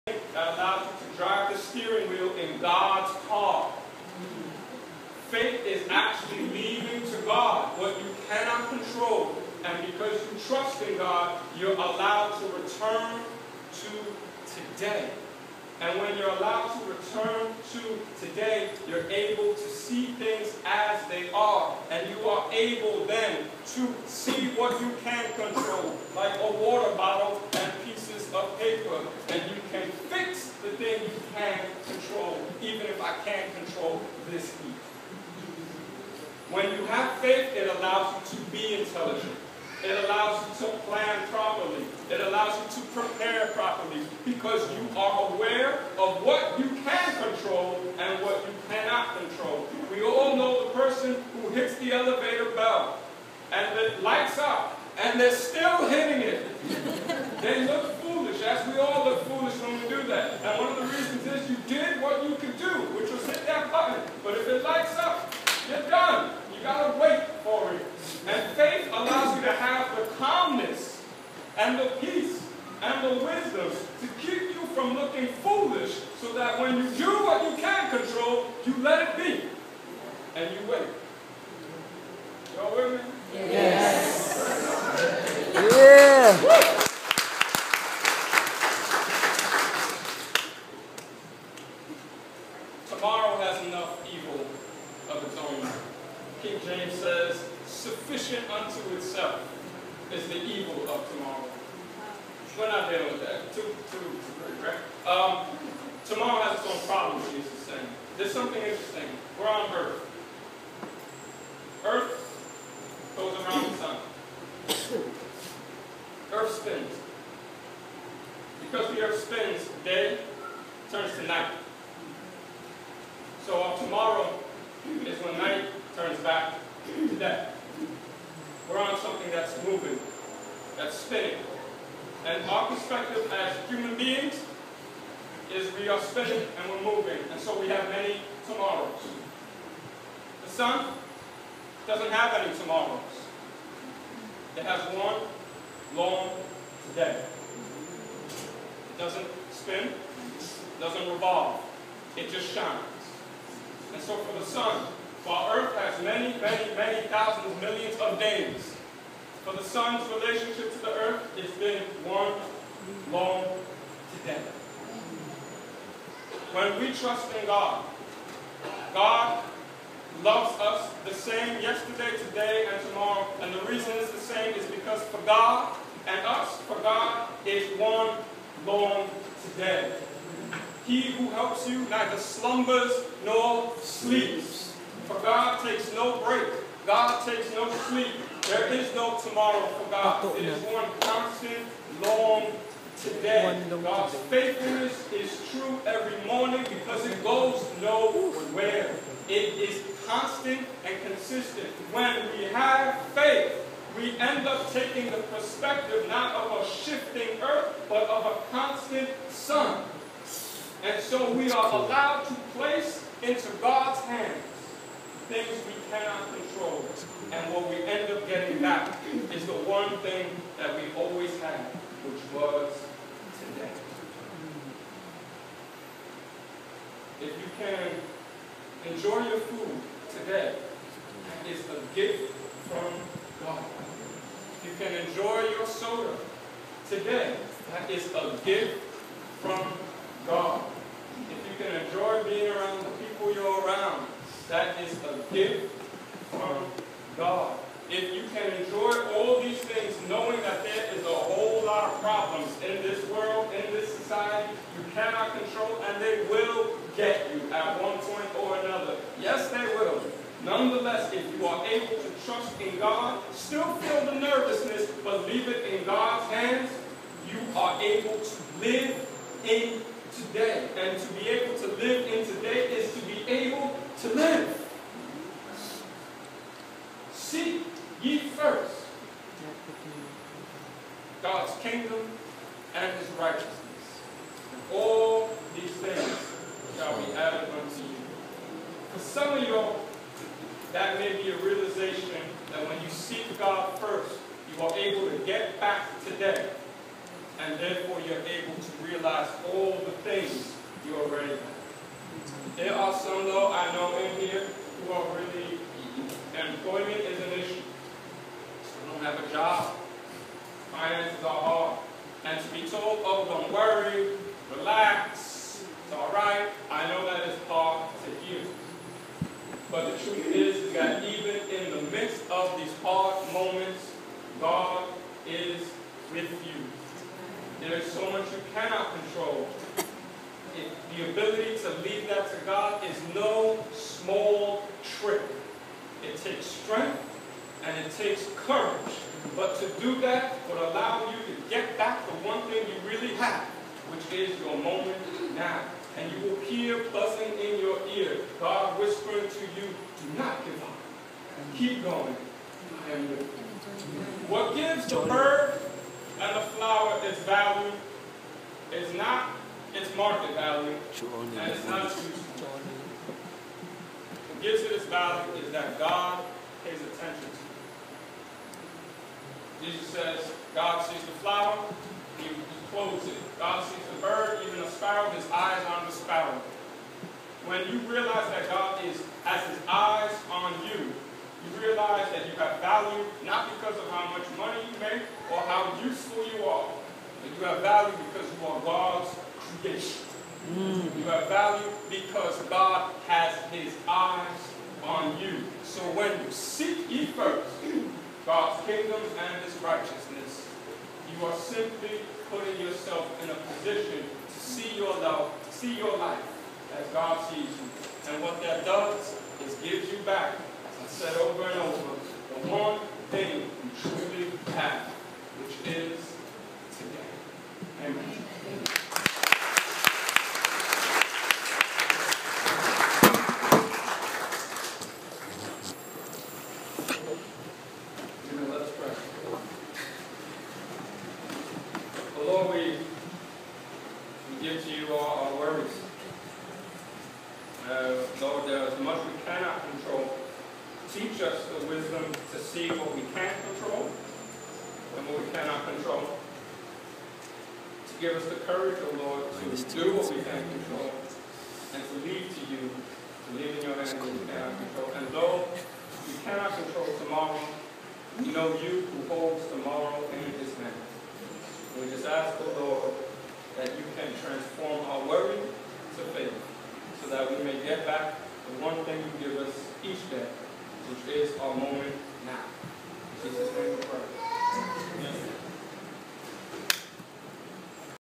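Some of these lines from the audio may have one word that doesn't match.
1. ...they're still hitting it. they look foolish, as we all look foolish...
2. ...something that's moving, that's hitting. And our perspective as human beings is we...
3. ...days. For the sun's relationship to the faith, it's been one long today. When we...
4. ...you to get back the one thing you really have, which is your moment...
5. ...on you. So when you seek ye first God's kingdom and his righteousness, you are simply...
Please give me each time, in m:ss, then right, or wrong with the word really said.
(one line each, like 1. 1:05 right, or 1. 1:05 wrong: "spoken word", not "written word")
1. 0:55 right
2. 2:08 wrong: "spinning", not "hitting"
3. 2:38 wrong: "earth", not "faith"
4. 5:41 right
5. 6:34 right.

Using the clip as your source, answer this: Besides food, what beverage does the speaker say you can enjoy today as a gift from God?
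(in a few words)
soda.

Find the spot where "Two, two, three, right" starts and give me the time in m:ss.
1:43.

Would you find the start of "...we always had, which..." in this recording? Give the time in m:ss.
3:40.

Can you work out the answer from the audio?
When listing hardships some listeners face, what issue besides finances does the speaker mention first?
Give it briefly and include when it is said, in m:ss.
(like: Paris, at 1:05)
employment, at 5:06.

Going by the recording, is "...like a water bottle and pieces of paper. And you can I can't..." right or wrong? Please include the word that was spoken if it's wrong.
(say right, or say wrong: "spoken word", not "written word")
right.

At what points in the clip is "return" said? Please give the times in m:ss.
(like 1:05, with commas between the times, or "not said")
0:12, 0:16.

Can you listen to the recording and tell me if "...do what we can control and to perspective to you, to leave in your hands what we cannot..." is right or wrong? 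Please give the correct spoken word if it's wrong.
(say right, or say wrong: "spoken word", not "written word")
wrong: "leave", not "perspective".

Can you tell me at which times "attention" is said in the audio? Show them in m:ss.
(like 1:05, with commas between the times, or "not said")
6:06.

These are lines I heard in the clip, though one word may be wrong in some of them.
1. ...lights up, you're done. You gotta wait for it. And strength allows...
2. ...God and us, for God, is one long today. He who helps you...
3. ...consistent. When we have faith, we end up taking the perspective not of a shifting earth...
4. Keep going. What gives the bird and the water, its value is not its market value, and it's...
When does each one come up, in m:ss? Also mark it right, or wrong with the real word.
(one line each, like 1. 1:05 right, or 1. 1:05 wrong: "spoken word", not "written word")
1. 1:04 wrong: "faith", not "strength"
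2. 2:55 right
3. 3:21 right
4. 5:51 wrong: "flower", not "water".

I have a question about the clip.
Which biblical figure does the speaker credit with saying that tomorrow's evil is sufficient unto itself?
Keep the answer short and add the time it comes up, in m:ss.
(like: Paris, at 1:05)
James, at 1:36.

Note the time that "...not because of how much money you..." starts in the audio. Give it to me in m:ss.
6:23.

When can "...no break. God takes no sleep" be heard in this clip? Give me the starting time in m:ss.
3:05.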